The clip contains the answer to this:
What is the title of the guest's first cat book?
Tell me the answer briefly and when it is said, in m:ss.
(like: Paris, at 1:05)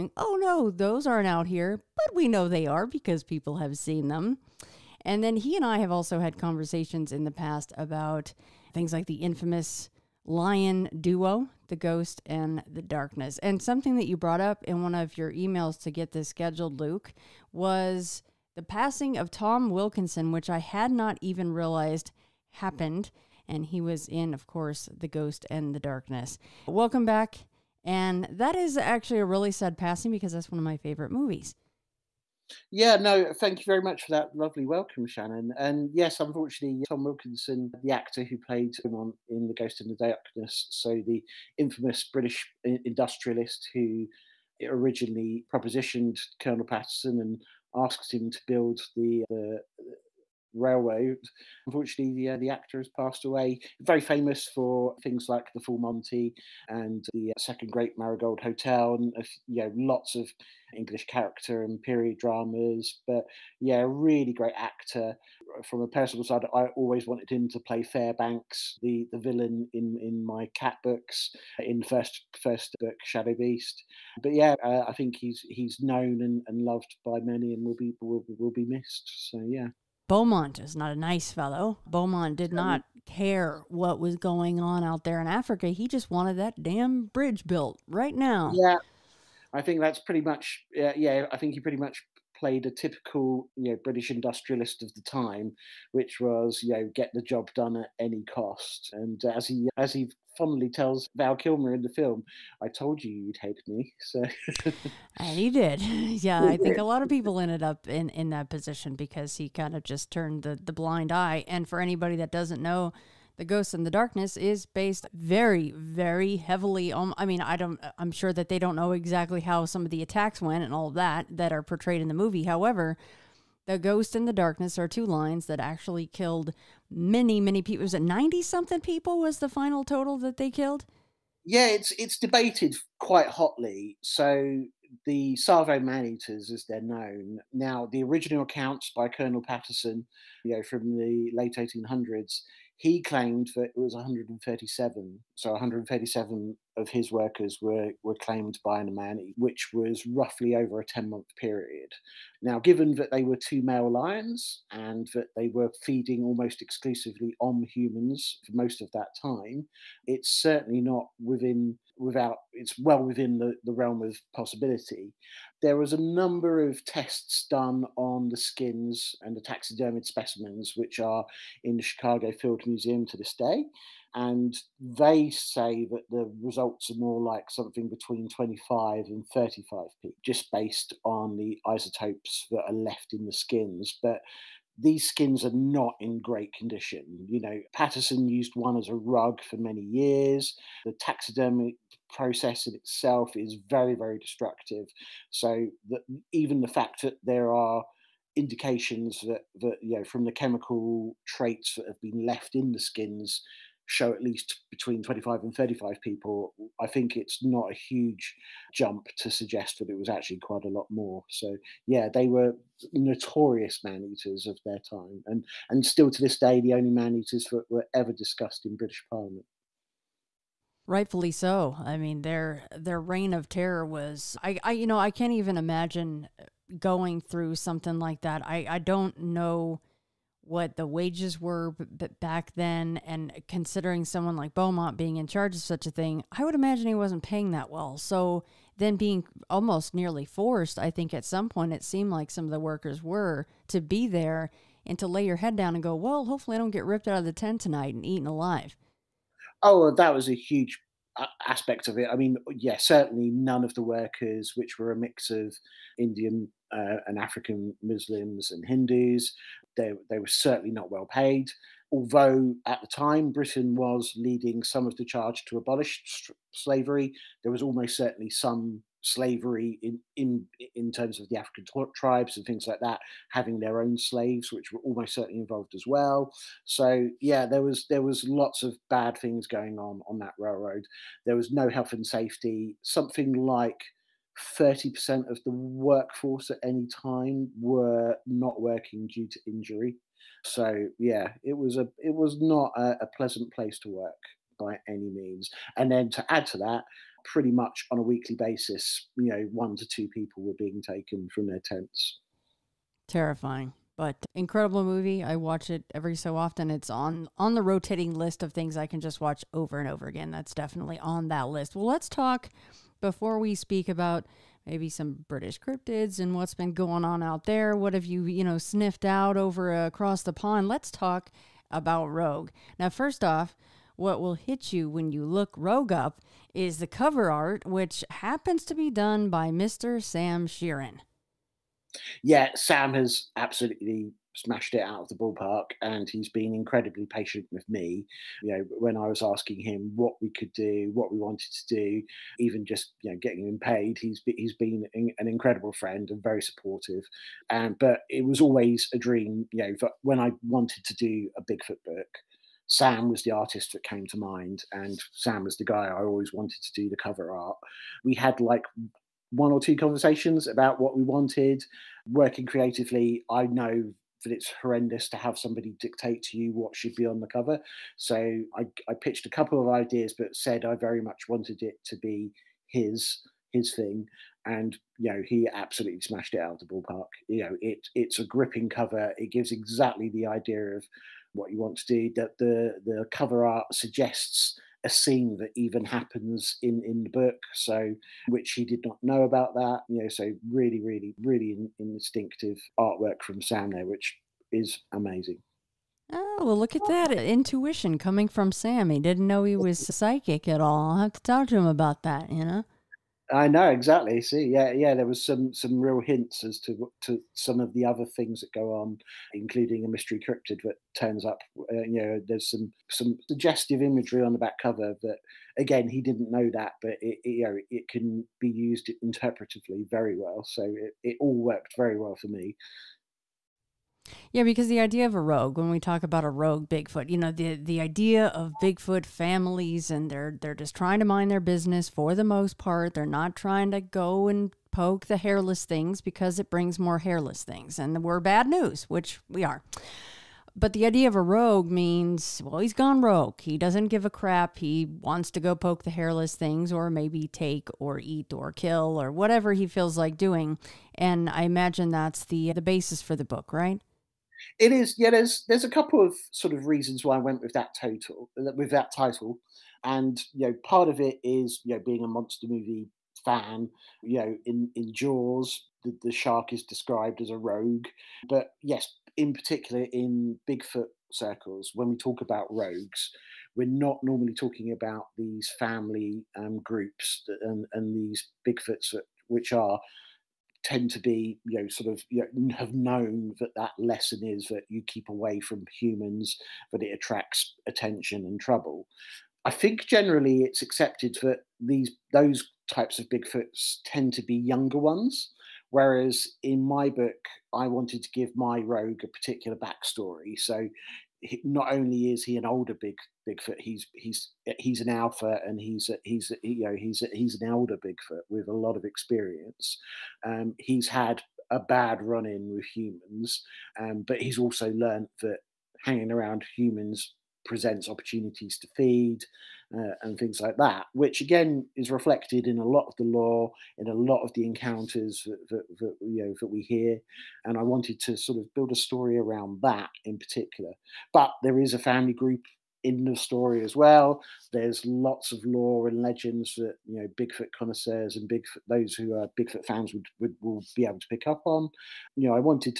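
Shadow Beast, at 1:13.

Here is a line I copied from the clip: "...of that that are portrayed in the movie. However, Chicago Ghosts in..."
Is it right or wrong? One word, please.
wrong.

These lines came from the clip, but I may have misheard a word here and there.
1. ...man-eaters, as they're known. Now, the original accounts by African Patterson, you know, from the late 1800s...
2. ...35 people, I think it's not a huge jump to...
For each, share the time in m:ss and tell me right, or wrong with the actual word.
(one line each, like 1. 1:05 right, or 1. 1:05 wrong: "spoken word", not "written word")
1. 2:15 wrong: "Colonel", not "African"
2. 3:25 right.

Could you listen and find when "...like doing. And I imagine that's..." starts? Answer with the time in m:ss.
7:29.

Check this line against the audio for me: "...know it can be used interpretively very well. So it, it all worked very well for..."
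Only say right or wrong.
right.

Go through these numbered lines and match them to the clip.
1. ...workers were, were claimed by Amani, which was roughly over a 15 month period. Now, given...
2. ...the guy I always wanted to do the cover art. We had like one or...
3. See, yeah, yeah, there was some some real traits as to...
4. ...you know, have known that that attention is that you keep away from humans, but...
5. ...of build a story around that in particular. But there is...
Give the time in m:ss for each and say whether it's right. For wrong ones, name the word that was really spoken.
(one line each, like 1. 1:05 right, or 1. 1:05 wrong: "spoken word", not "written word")
1. 2:27 wrong: "10", not "15"
2. 5:55 right
3. 6:44 wrong: "hints", not "traits"
4. 8:02 wrong: "lesson", not "attention"
5. 8:48 right.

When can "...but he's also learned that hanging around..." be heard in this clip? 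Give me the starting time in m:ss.
8:34.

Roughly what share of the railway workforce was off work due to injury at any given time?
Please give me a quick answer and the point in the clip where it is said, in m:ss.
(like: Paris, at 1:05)
30%, at 4:44.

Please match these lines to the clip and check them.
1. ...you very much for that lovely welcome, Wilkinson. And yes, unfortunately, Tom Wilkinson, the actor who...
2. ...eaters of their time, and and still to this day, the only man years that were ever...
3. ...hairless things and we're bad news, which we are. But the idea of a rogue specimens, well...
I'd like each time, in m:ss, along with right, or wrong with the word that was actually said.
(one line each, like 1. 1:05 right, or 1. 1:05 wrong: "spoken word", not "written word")
1. 0:33 wrong: "Shannon", not "Wilkinson"
2. 3:34 wrong: "eaters", not "years"
3. 7:16 wrong: "means", not "specimens".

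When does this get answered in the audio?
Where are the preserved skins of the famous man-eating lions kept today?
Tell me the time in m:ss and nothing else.
2:51.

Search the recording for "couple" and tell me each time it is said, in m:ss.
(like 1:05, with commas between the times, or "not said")
6:09, 7:35.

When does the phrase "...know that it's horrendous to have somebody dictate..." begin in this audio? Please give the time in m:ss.
6:03.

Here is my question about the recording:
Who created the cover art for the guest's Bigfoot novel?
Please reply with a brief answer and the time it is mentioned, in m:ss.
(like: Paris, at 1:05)
Sam Shearon, at 5:30.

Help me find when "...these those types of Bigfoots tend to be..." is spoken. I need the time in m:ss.
8:11.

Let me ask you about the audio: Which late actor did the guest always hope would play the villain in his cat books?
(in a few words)
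Fairbanks.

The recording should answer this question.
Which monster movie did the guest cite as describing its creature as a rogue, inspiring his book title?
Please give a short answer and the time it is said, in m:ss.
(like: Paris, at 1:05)
Jaws, at 7:44.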